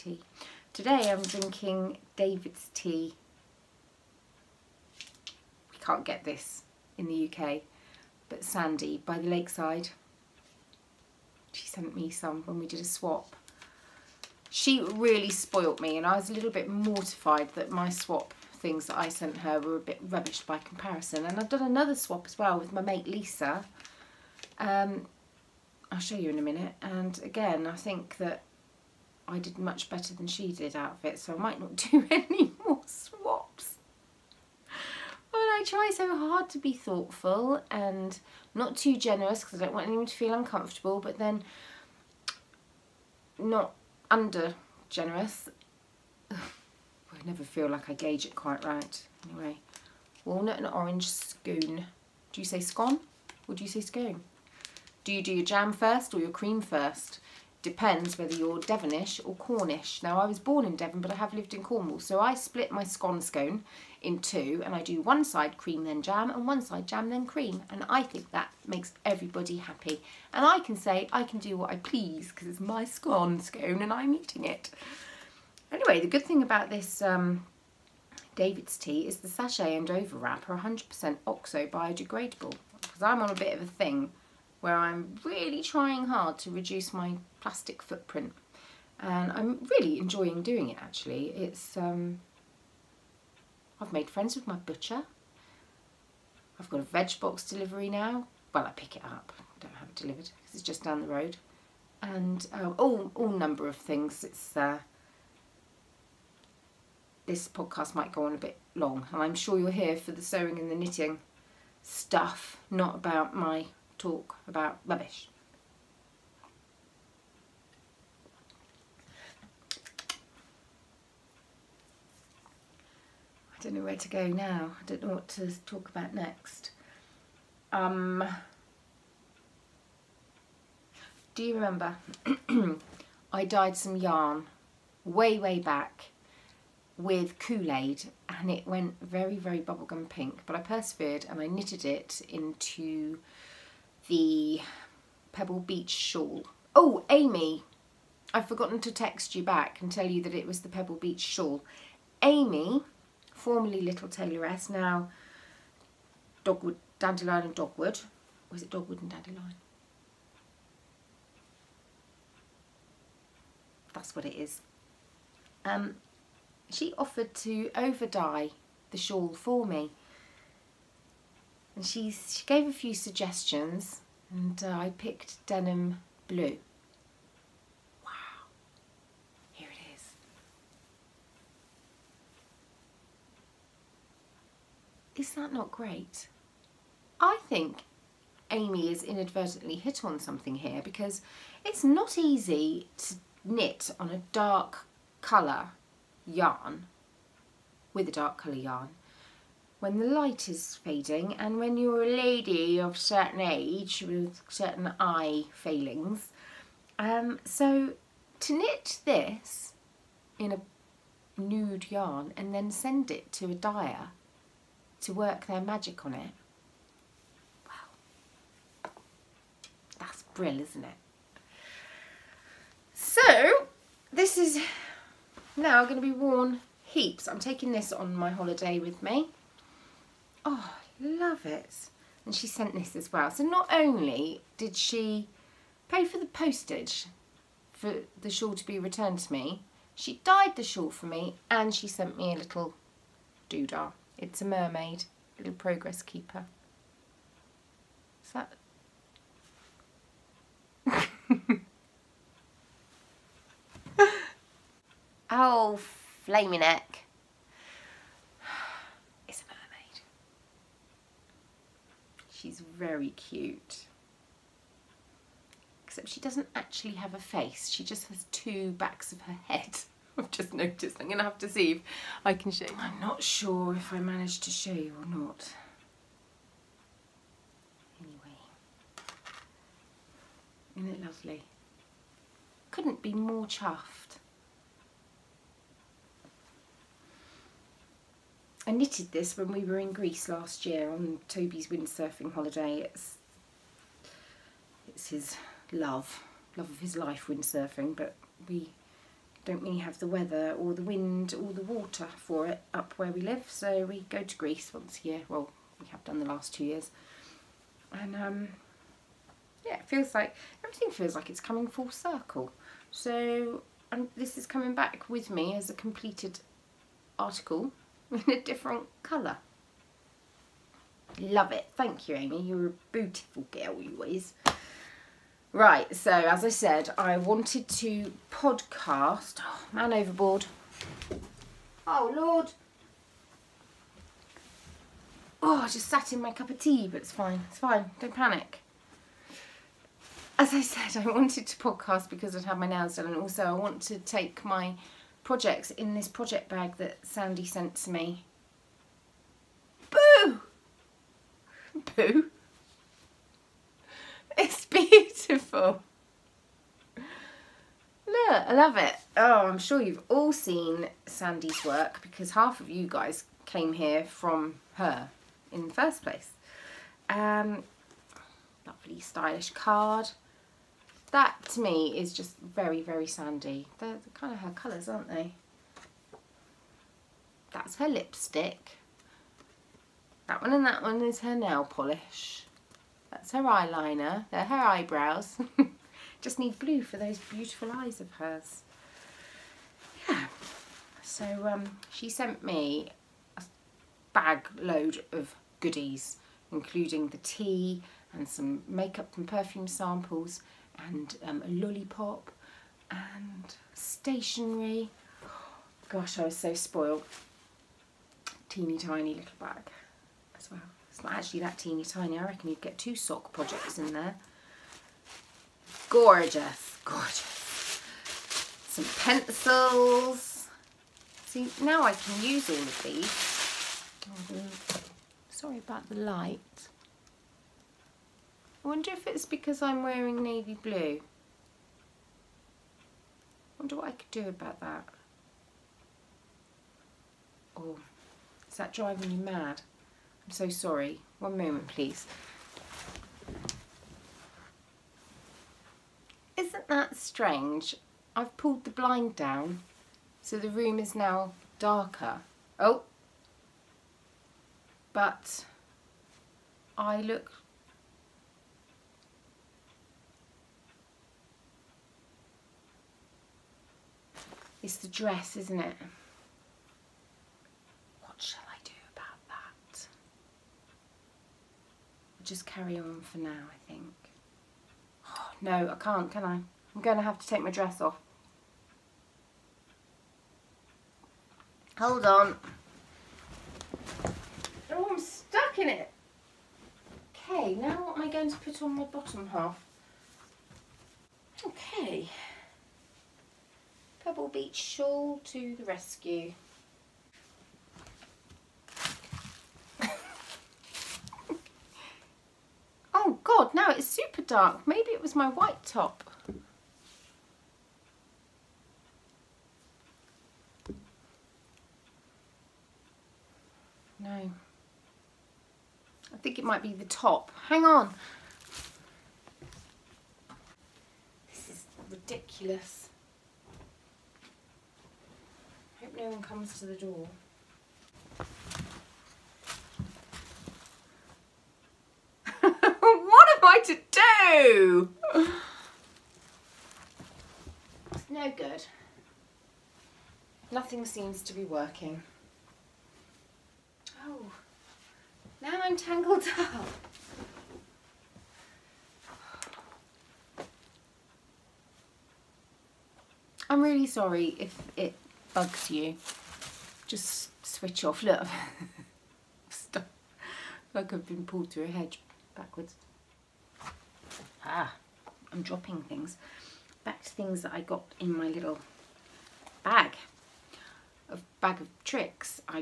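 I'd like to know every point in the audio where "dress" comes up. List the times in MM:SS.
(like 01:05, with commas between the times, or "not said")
07:44, 07:57.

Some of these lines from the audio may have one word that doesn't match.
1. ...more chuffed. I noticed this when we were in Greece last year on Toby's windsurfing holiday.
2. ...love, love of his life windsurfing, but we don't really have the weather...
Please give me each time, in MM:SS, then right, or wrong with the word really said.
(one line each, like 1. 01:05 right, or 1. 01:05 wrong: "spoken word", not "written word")
1. 04:43 wrong: "knitted", not "noticed"
2. 04:55 right.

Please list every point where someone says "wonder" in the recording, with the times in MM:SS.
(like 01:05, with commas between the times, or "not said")
07:08, 07:13.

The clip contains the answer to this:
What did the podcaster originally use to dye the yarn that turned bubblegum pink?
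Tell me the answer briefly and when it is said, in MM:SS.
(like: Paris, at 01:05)
Kool-Aid, at 02:17.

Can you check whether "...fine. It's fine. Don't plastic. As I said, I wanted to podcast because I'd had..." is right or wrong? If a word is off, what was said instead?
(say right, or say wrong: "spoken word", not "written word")
wrong: "panic", not "plastic".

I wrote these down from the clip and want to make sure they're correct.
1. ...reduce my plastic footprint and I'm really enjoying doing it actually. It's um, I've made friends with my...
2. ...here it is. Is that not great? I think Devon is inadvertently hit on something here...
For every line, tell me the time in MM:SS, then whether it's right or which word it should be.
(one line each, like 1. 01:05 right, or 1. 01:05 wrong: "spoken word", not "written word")
1. 01:26 right
2. 02:59 wrong: "Amy", not "Devon".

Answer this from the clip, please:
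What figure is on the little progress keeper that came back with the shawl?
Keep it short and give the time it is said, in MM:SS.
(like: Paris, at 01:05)
A mermaid, at 04:04.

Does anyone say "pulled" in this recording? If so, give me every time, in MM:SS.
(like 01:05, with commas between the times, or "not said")
07:28, 09:21.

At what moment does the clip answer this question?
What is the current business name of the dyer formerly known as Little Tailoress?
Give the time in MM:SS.
02:36.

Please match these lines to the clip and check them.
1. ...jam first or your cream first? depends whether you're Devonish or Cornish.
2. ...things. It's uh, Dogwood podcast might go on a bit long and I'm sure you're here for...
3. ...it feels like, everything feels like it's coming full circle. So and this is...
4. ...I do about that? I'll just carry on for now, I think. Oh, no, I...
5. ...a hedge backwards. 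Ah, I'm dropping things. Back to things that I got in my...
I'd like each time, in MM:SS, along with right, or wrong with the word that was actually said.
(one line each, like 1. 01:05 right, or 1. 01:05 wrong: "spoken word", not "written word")
1. 00:55 right
2. 01:43 wrong: "This", not "Dogwood"
3. 05:09 right
4. 07:48 right
5. 09:21 right.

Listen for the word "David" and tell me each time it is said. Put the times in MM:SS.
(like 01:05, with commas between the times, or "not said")
00:02, 01:18.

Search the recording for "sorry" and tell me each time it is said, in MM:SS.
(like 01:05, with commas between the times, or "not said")
07:05, 07:20, 09:13.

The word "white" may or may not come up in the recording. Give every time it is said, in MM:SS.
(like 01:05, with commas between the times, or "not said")
08:25.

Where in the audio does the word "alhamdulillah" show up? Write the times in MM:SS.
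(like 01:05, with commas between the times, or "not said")
not said.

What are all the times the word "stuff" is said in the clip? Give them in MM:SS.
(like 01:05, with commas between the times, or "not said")
01:51, 09:19.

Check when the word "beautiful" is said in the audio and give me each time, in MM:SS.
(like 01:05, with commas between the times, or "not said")
05:22, 05:54, 06:27.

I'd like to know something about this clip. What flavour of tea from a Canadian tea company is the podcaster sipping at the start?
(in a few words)
Walnut and orange scone.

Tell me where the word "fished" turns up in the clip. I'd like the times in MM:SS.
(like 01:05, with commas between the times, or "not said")
not said.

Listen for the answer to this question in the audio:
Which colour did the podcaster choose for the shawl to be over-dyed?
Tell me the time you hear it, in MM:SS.
02:55.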